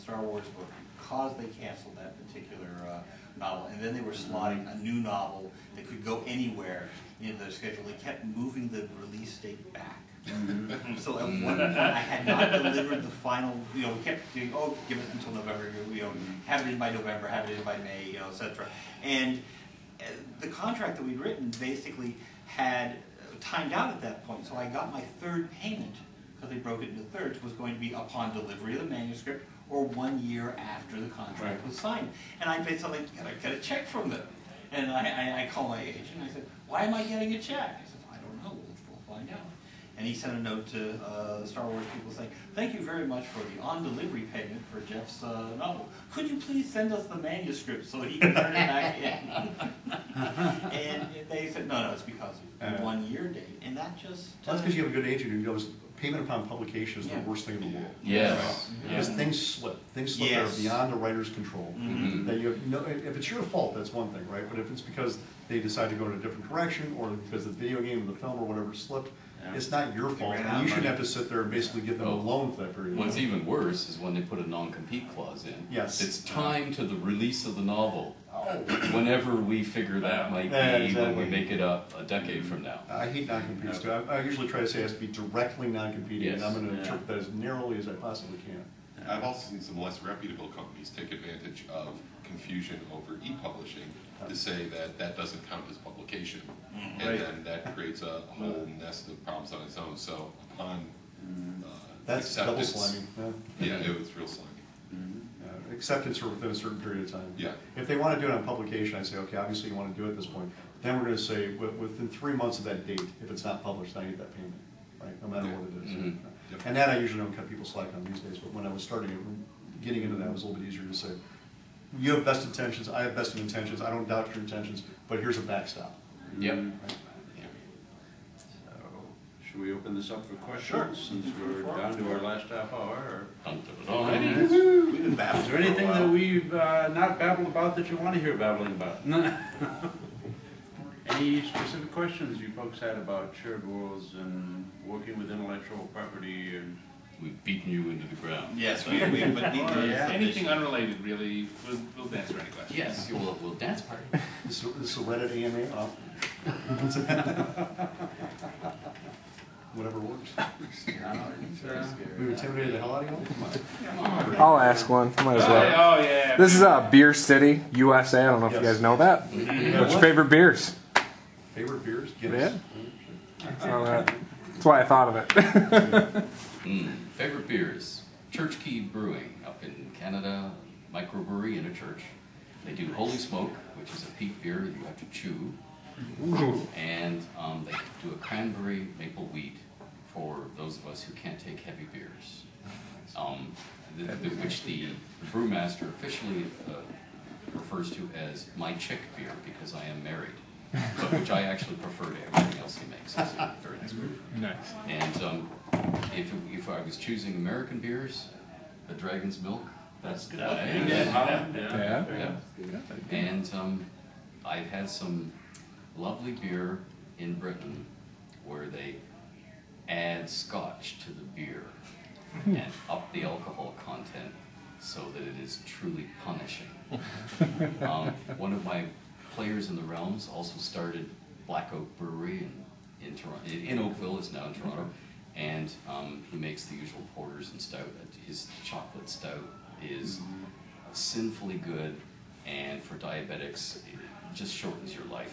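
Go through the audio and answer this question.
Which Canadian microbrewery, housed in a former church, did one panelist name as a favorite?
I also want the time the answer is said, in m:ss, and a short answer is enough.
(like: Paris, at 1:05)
Church Key Brewing, at 2:58.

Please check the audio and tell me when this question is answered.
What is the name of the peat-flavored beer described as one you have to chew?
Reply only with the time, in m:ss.
3:02.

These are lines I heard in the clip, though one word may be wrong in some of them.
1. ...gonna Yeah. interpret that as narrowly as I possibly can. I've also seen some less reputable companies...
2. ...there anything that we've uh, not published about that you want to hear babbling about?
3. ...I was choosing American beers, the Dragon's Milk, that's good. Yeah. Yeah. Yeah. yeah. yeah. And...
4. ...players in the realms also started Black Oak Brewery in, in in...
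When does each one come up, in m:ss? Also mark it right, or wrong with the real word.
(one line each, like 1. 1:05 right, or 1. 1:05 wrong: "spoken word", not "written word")
1. 1:26 right
2. 2:15 wrong: "babbled", not "published"
3. 3:26 right
4. 3:49 right.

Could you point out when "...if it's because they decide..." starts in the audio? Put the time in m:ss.
1:04.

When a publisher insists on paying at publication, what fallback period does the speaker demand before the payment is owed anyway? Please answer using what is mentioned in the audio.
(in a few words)
3 months.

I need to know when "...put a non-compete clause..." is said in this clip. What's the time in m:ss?
1:14.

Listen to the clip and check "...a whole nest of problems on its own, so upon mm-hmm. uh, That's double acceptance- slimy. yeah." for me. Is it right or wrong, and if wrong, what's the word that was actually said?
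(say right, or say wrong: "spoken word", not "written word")
right.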